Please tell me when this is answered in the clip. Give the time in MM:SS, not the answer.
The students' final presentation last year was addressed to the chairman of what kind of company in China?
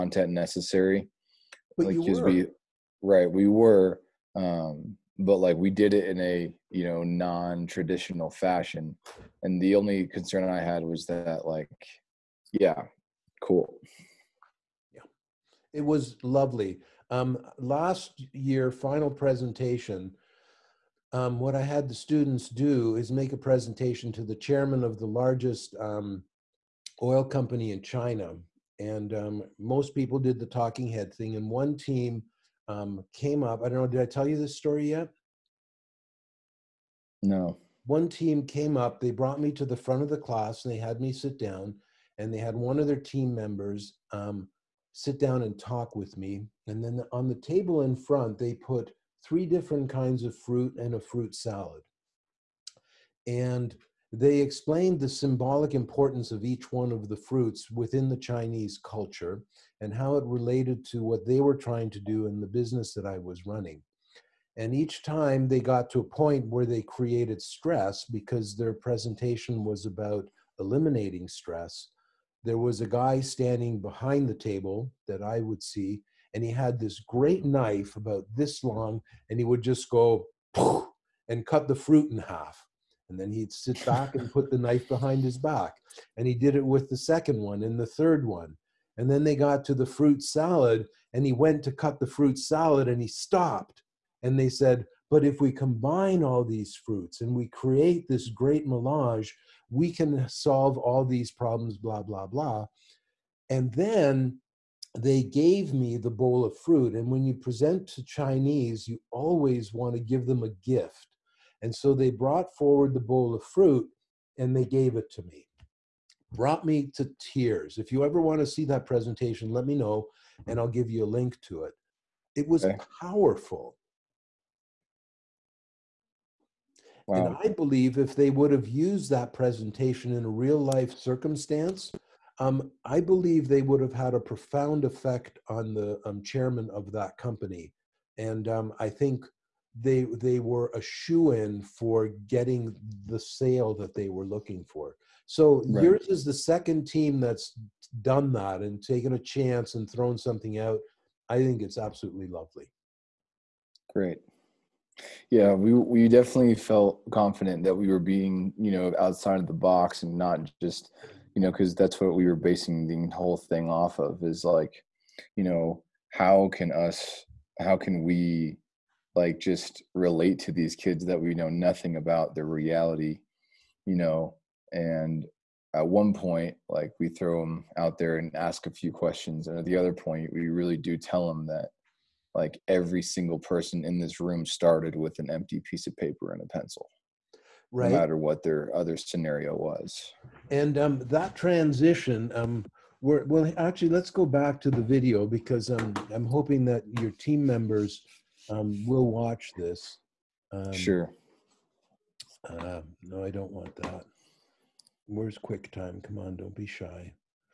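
00:27.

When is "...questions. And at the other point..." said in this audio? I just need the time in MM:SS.
02:58.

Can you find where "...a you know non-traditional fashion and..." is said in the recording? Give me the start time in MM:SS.
00:06.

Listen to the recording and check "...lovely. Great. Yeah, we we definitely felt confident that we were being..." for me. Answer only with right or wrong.
right.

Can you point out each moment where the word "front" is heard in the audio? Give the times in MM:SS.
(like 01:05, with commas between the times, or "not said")
00:39, 00:47.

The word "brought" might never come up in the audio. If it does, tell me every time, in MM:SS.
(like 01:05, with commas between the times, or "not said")
00:39, 01:52, 01:56.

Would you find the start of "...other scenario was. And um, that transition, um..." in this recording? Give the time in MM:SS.
03:08.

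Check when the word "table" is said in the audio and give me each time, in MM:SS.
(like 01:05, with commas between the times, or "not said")
00:47, 01:14.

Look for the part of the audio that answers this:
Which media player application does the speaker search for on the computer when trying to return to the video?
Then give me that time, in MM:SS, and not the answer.
03:25.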